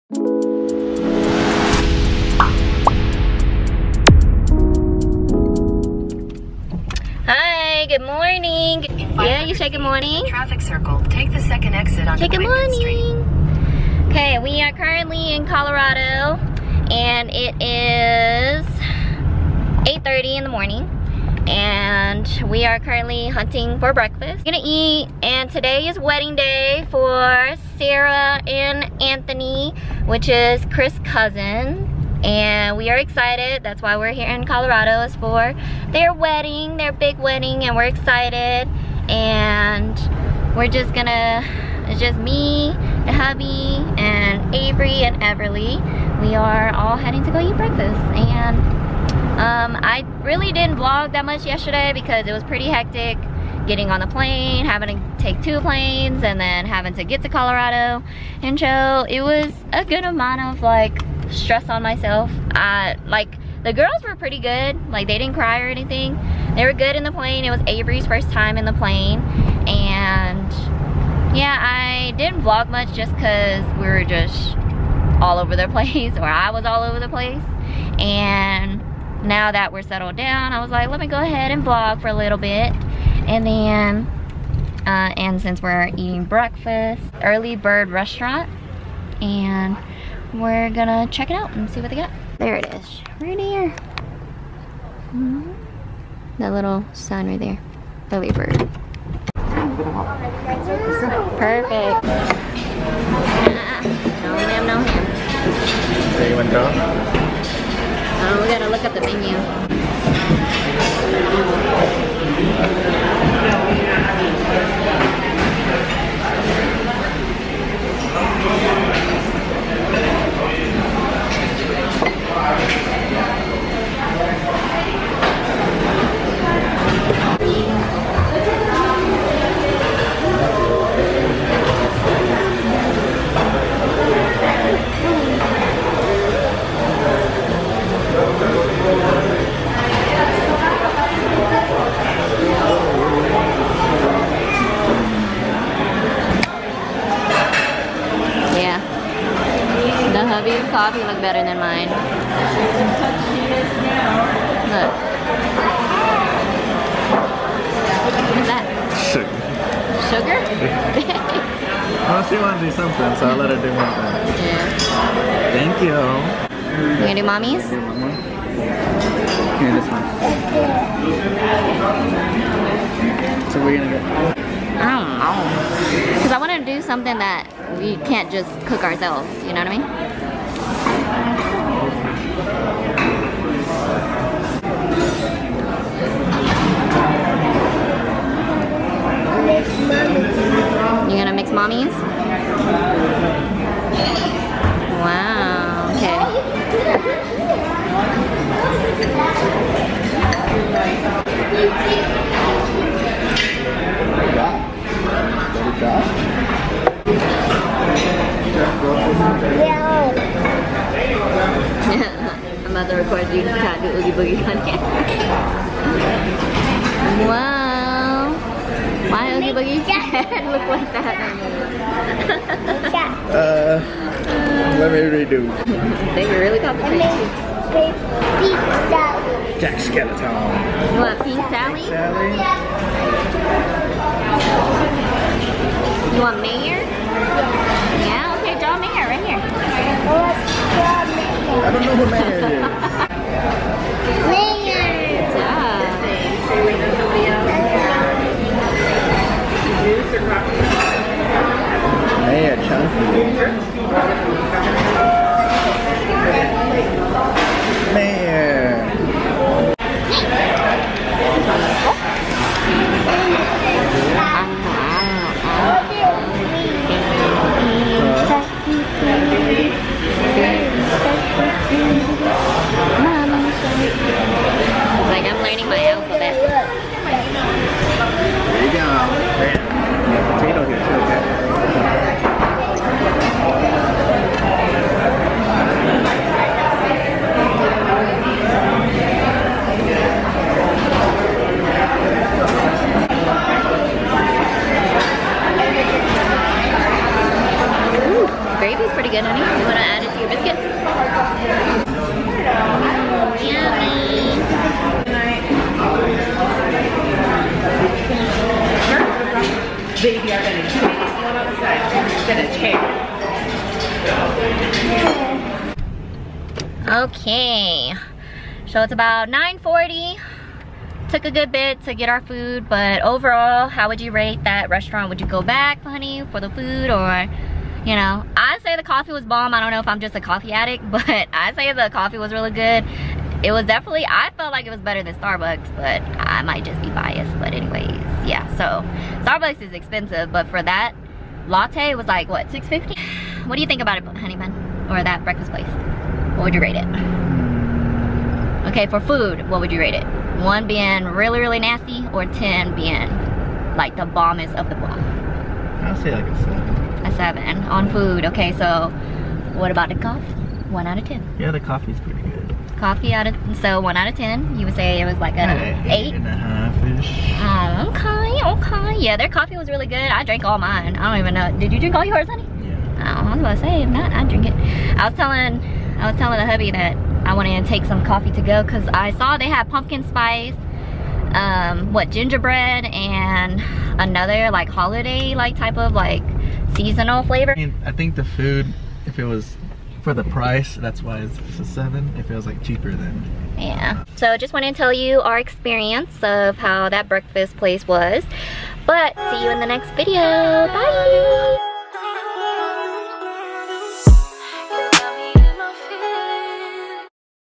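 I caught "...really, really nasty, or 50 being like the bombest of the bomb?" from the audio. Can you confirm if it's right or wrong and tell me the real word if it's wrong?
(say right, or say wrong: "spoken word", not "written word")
wrong: "10", not "50".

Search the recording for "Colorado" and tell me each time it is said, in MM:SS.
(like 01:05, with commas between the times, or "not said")
00:15, 00:34, 00:57.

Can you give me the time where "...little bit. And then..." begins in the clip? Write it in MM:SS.
01:22.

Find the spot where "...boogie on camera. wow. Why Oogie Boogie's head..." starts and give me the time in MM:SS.
03:34.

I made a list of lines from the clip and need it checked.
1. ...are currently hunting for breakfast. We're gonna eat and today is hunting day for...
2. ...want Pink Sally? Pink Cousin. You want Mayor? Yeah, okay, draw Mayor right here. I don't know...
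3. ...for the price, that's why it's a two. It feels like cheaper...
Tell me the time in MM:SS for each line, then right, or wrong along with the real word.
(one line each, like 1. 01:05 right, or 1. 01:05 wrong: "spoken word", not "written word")
1. 00:22 wrong: "wedding", not "hunting"
2. 03:51 wrong: "Sally", not "Cousin"
3. 06:30 wrong: "seven", not "two".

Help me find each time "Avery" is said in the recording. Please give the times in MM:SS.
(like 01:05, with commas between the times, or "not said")
00:44, 01:07.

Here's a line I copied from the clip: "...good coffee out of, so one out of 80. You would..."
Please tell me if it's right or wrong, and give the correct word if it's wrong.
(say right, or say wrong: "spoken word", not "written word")
wrong: "10", not "80".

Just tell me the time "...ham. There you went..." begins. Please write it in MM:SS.
01:44.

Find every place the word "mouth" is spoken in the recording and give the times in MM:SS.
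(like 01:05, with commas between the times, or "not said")
not said.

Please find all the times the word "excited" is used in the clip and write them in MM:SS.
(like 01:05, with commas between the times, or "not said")
00:32, 00:37.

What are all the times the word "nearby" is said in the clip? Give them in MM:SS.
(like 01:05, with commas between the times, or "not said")
not said.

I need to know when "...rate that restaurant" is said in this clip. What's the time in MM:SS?
05:24.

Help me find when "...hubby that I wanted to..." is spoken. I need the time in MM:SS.
06:16.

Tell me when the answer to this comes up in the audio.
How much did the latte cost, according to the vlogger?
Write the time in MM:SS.
05:42.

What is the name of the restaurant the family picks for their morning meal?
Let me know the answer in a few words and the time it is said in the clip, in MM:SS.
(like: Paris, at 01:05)
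Early Bird Restaurant, at 01:27.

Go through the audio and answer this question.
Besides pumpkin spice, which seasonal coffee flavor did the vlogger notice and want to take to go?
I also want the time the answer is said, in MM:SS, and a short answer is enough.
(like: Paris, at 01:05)
gingerbread, at 06:22.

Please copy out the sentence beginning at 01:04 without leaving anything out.
Like they didn't cry or anything.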